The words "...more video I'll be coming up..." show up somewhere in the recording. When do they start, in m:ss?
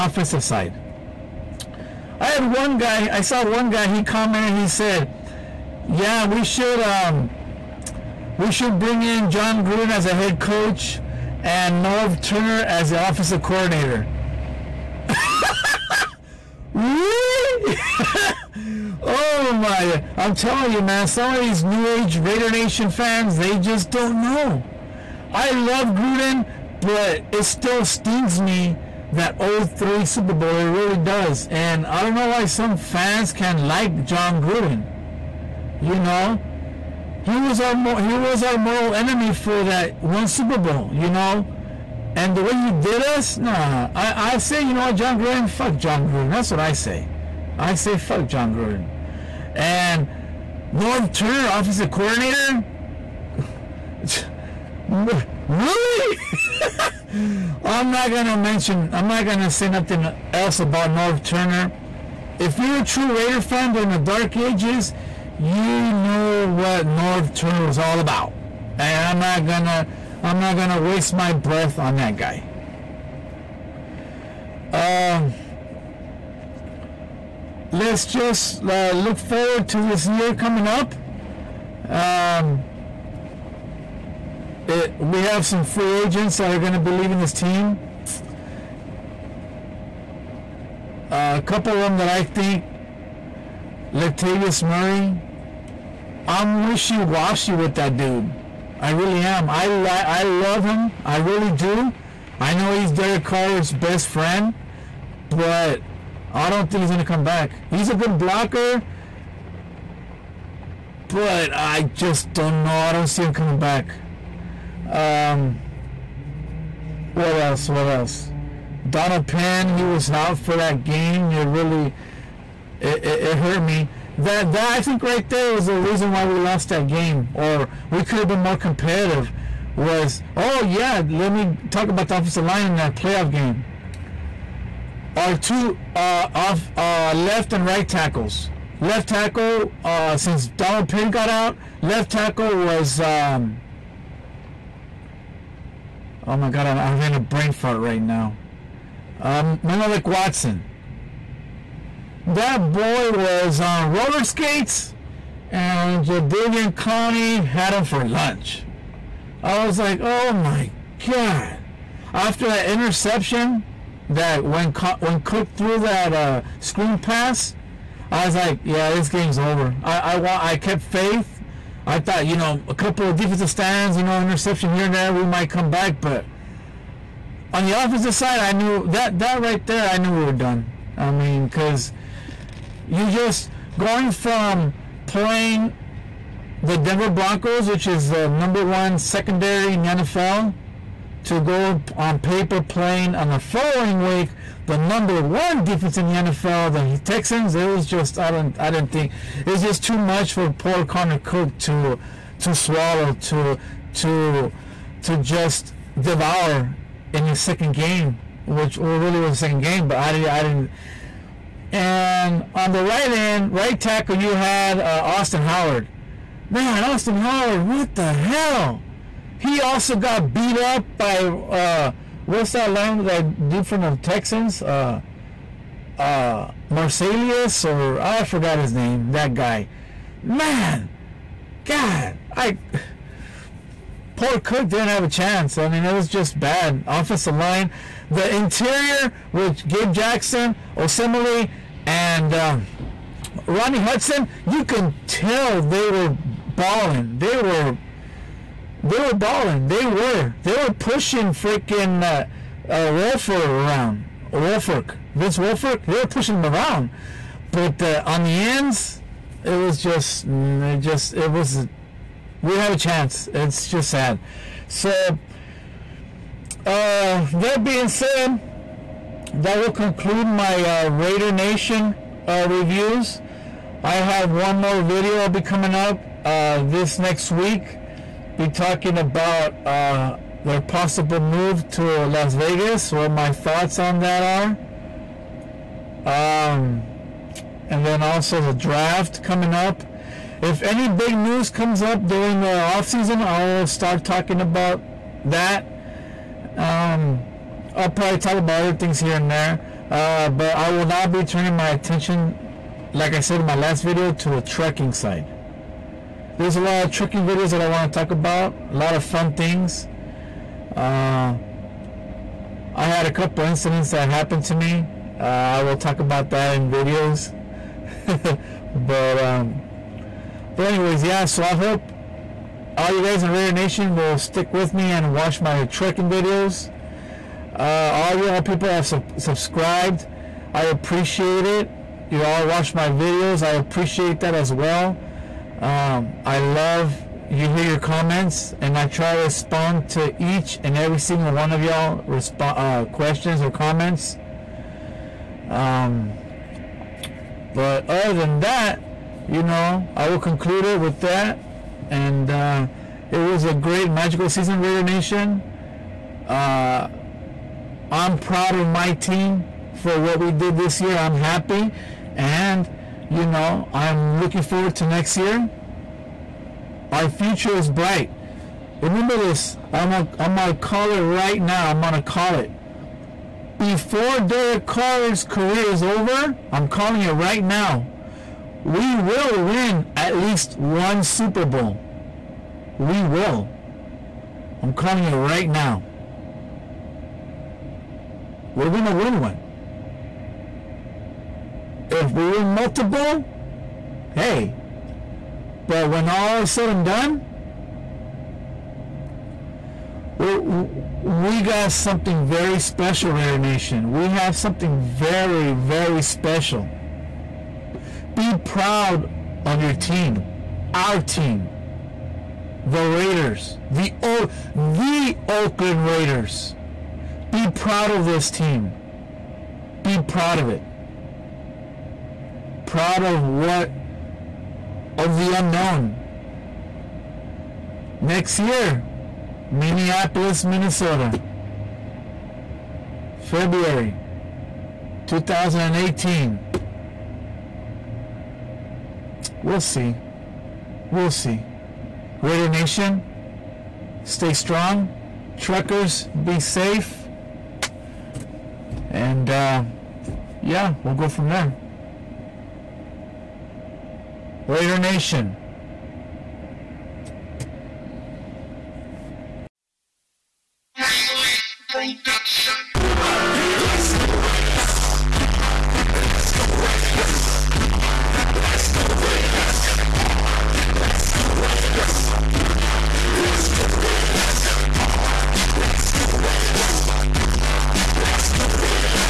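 4:34.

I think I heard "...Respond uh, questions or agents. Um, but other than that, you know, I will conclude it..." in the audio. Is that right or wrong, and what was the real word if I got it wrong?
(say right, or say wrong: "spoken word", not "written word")
wrong: "comments", not "agents".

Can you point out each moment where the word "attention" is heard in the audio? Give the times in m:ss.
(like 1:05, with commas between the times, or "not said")
5:01.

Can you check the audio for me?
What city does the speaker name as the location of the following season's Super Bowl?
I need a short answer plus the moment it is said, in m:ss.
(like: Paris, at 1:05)
Minneapolis, at 7:09.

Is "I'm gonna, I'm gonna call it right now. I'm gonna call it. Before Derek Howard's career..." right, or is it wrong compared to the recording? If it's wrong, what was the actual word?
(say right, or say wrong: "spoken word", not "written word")
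wrong: "Carr", not "Howard".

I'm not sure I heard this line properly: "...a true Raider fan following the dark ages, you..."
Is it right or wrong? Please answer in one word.
wrong.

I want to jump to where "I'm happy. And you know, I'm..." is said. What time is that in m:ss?
6:00.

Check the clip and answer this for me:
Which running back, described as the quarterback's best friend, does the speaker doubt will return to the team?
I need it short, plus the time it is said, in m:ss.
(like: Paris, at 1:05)
Latavius Murray, at 1:33.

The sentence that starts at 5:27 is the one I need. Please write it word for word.
Uh, all you all people have subscribed.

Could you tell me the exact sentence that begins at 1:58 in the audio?
Donald Penn, he was out for that game.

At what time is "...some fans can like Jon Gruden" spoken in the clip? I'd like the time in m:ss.
0:32.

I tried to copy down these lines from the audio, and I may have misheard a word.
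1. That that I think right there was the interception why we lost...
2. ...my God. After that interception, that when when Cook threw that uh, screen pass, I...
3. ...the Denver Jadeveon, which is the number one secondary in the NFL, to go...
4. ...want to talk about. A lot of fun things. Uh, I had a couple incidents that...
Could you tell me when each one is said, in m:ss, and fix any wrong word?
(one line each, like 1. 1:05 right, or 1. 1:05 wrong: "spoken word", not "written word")
1. 2:04 wrong: "reason", not "interception"
2. 2:40 right
3. 3:06 wrong: "Broncos", not "Jadeveon"
4. 5:07 right.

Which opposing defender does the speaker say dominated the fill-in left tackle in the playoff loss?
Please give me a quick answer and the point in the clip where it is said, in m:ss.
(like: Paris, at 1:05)
Jadeveon Clowney, at 2:36.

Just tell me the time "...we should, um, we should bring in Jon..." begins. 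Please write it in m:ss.
0:06.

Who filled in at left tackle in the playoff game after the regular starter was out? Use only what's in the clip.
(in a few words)
Menelik Watson.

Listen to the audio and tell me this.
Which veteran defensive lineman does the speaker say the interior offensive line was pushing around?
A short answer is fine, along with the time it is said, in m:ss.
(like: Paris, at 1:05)
Vince Wilfork, at 4:15.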